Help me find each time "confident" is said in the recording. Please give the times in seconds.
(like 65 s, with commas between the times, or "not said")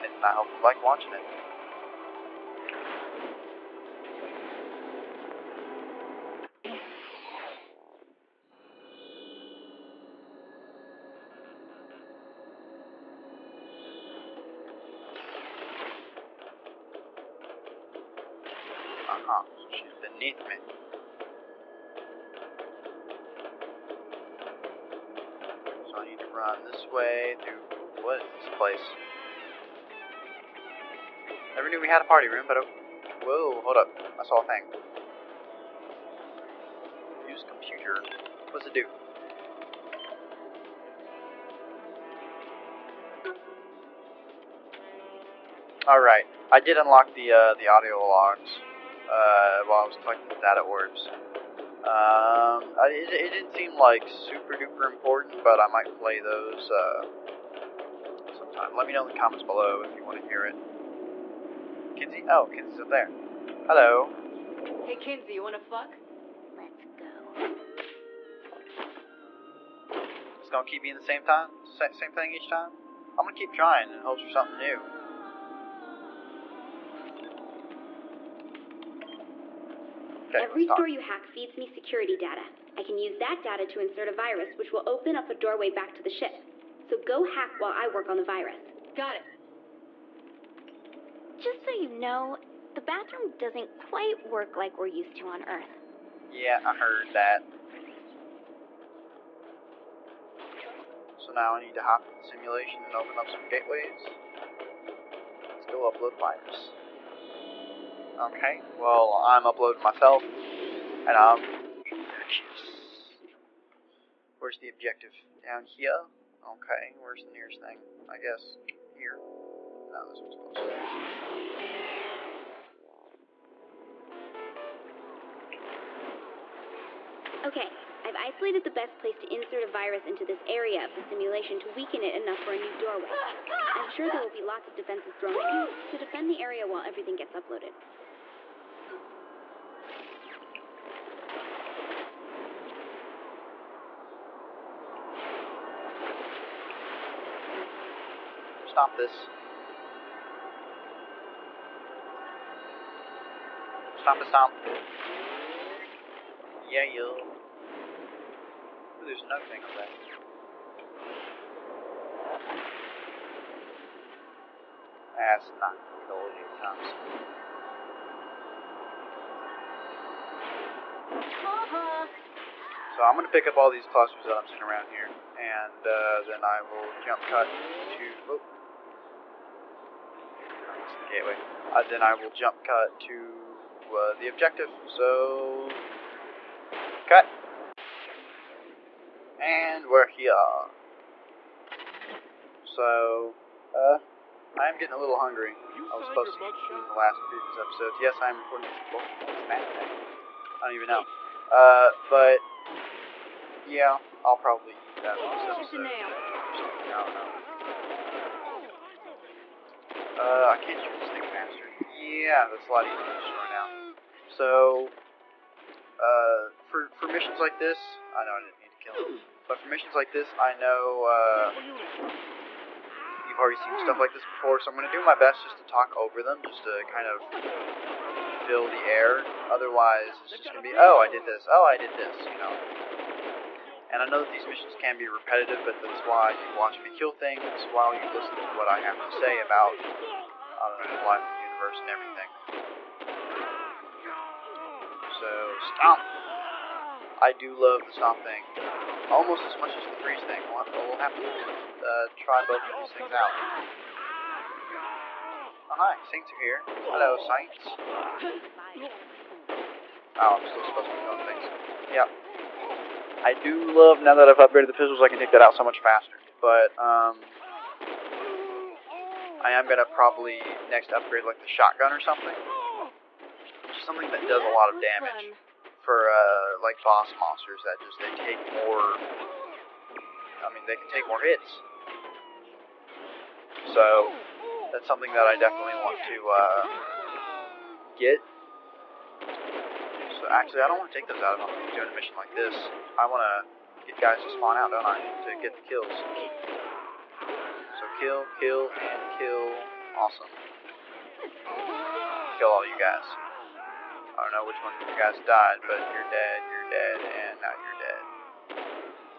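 not said.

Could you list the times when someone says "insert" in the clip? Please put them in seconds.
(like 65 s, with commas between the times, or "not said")
83 s, 129 s.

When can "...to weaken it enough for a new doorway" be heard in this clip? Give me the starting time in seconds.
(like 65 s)
131 s.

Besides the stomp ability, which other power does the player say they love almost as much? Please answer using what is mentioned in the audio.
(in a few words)
freeze.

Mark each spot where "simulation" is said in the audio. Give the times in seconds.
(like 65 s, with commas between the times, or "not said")
102 s, 131 s.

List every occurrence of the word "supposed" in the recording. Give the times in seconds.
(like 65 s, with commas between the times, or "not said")
196 s, 260 s.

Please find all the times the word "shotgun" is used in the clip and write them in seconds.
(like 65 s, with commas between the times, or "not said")
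271 s.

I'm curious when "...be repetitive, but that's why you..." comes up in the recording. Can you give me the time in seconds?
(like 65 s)
234 s.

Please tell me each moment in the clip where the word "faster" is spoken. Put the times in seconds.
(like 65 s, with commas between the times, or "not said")
211 s, 265 s.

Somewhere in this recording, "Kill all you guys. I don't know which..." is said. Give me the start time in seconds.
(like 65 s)
302 s.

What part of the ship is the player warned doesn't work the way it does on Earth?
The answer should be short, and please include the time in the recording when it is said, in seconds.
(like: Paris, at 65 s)
the bathroom, at 92 s.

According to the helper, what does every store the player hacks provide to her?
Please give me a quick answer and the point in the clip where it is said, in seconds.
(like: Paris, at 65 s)
security data, at 81 s.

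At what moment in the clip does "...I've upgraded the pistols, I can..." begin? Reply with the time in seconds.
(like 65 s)
264 s.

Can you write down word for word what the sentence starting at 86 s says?
So go hack while I work on the virus.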